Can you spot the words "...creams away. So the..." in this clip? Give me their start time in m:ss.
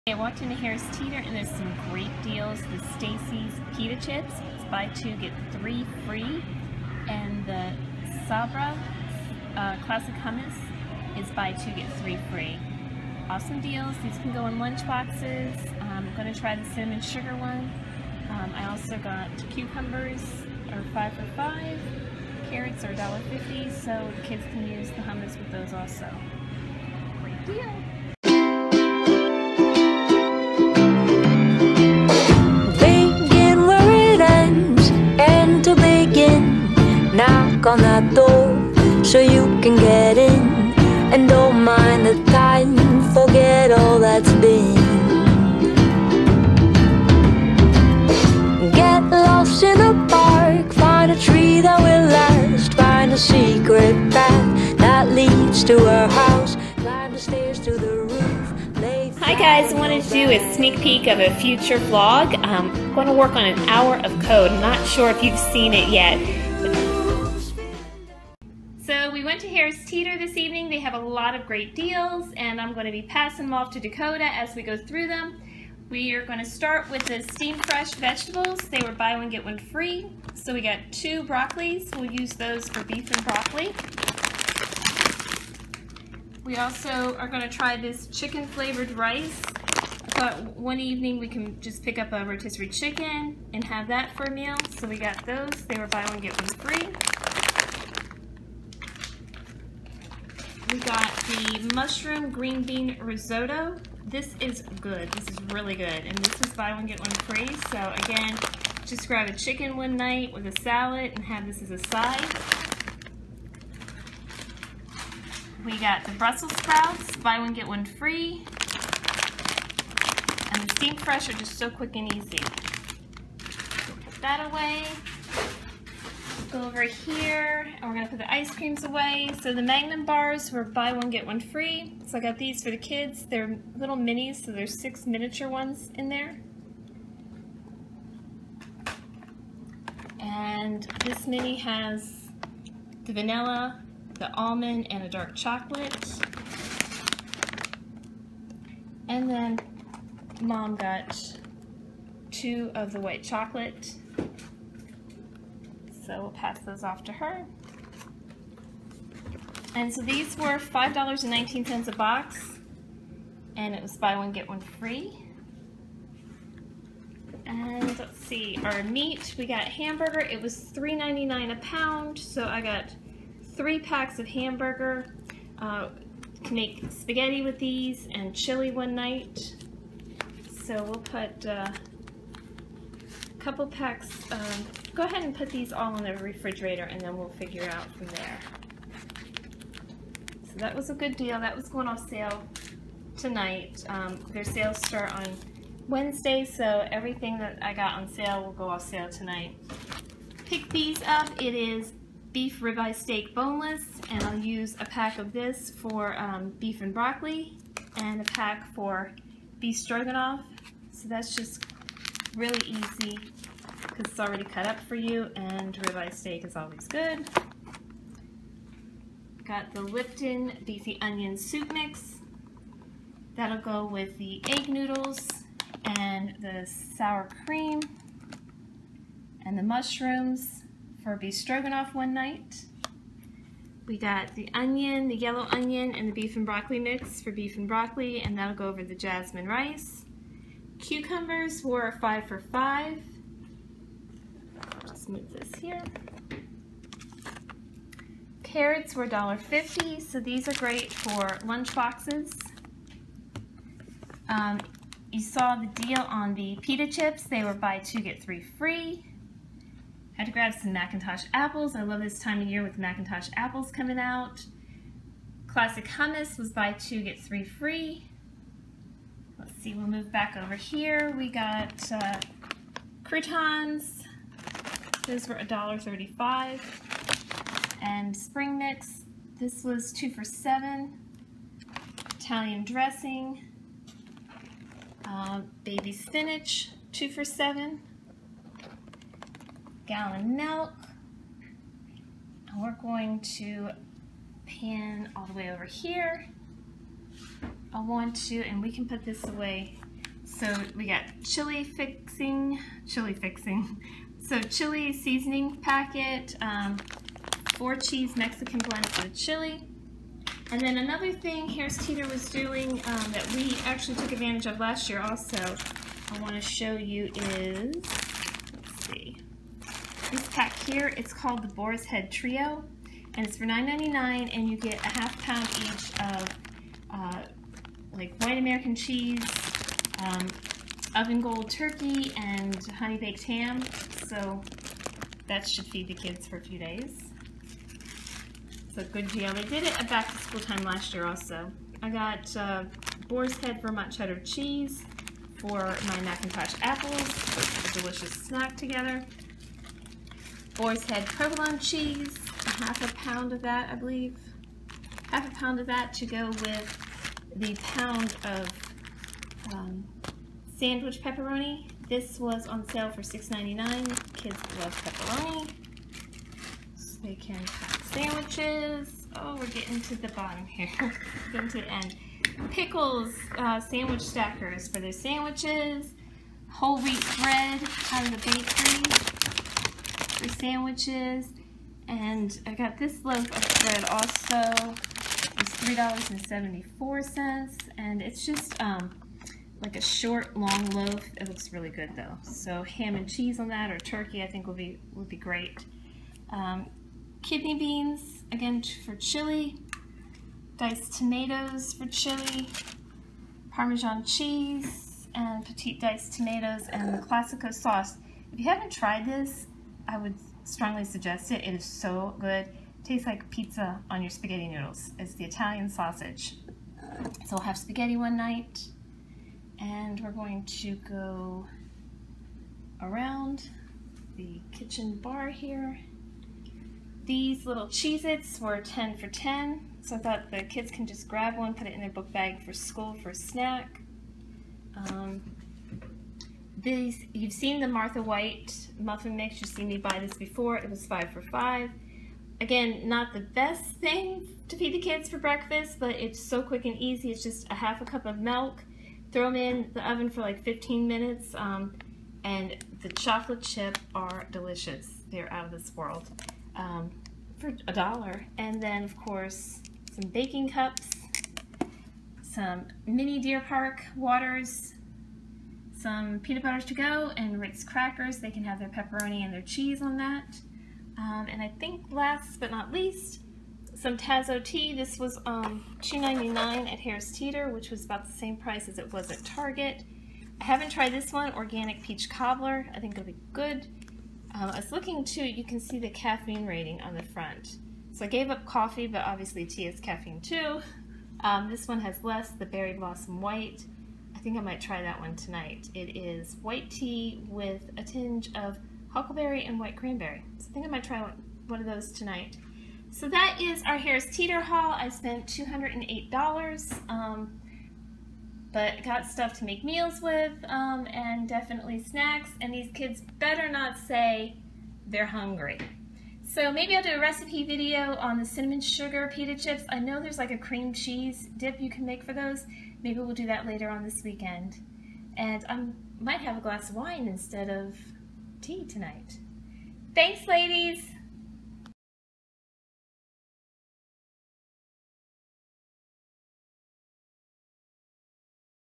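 2:08.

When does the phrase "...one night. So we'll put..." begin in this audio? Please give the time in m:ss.
2:58.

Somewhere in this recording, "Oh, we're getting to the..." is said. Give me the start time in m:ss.
6:09.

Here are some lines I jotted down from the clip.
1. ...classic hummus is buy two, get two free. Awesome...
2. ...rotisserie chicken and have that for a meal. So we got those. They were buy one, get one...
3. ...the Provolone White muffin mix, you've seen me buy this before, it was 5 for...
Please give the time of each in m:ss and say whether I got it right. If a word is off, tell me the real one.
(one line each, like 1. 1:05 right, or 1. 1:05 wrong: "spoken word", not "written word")
1. 0:09 wrong: "three", not "two"
2. 1:32 right
3. 7:17 wrong: "Martha", not "Provolone".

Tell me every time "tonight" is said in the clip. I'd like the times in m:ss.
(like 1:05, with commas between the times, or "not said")
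3:13, 3:19, 8:15, 8:21, 8:48.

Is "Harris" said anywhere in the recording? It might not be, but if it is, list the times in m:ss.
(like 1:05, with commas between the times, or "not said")
0:00, 1:09, 5:11, 7:56, 8:23.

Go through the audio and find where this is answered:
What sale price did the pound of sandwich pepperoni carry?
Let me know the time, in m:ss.
6:03.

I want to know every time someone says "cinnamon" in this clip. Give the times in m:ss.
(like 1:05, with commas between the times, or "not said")
0:16, 8:38.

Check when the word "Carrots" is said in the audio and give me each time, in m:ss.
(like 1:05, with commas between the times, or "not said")
0:22, 4:08.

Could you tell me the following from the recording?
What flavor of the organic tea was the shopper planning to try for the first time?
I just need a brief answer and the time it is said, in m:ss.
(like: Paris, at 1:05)
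Peach Cobbler, at 8:01.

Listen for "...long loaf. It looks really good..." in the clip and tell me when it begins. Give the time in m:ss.
6:30.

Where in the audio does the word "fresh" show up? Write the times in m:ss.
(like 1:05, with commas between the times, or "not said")
1:17, 2:01.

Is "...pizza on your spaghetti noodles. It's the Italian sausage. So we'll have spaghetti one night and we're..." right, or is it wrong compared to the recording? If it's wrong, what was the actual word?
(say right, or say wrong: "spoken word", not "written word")
right.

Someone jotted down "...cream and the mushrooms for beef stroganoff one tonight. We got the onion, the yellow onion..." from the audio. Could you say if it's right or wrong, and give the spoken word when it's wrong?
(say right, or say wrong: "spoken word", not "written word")
wrong: "night", not "tonight".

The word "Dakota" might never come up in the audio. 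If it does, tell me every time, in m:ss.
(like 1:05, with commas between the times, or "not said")
1:13.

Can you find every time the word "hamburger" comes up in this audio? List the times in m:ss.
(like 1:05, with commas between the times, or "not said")
2:49, 2:54.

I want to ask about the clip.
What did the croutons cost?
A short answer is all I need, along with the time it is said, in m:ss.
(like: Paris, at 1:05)
$1.35, at 4:35.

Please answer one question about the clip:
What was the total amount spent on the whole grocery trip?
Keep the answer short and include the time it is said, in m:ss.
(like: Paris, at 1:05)
$208, at 8:25.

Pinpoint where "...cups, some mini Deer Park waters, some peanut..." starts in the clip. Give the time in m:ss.
7:40.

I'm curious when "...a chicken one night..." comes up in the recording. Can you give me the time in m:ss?
1:49.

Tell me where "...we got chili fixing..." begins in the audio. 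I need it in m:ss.
5:00.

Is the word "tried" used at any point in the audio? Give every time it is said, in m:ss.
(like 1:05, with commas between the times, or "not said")
6:48, 8:00.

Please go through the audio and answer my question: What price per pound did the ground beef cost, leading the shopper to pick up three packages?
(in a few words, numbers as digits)
$3.99.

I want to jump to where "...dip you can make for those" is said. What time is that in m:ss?
8:41.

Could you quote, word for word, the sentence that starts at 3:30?
So that's just Really easy because it's already cut up for you and ribeye steak is always good.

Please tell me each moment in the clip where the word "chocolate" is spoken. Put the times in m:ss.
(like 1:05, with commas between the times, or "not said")
2:25, 2:33, 7:32.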